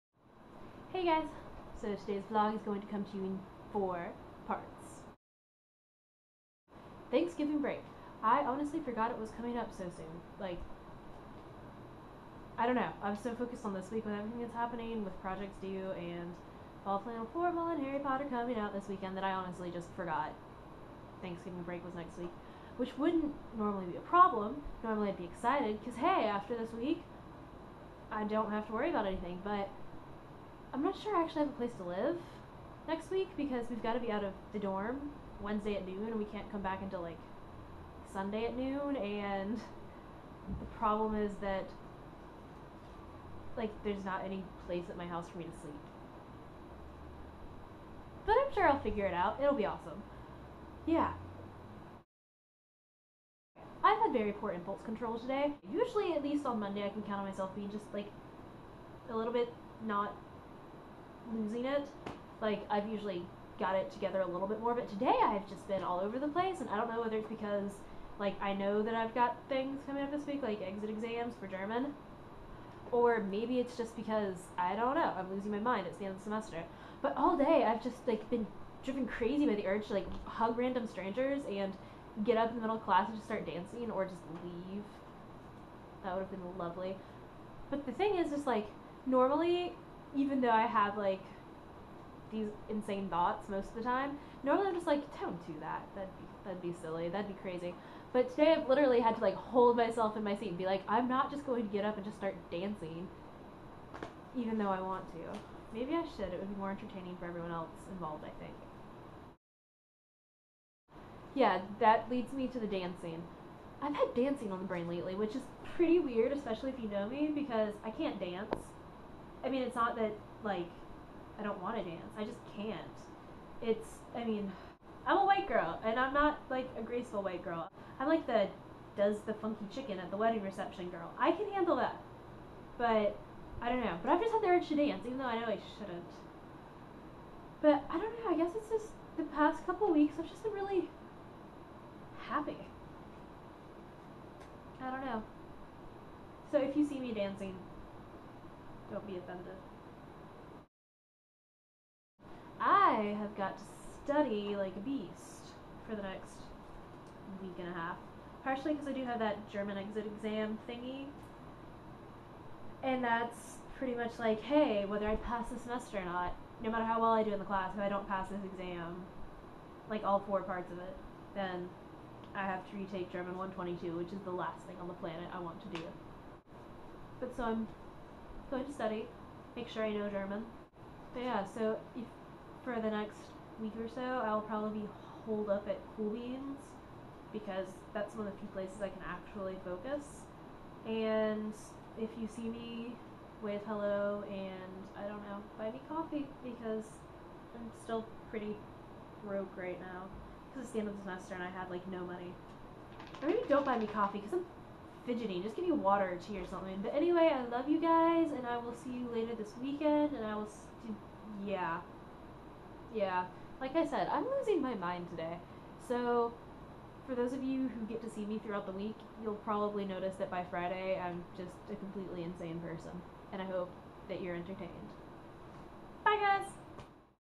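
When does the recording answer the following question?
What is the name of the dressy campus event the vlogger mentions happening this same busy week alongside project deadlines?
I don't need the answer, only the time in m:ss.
0:16.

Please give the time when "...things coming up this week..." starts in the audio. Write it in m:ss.
1:09.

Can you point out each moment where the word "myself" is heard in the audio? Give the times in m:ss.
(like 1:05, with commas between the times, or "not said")
0:57, 1:39.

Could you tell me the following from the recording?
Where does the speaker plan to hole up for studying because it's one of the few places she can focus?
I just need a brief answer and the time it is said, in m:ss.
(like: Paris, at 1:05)
Cool Beans, at 3:05.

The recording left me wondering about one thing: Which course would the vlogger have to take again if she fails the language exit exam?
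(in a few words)
German 122.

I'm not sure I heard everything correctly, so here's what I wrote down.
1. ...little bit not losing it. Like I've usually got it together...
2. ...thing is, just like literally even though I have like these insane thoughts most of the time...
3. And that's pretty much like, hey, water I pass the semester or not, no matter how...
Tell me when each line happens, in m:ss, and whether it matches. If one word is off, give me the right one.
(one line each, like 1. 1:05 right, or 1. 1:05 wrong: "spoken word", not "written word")
1. 0:59 right
2. 1:27 wrong: "normally", not "literally"
3. 2:42 wrong: "whether", not "water".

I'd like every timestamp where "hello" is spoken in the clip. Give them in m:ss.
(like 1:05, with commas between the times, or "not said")
3:13.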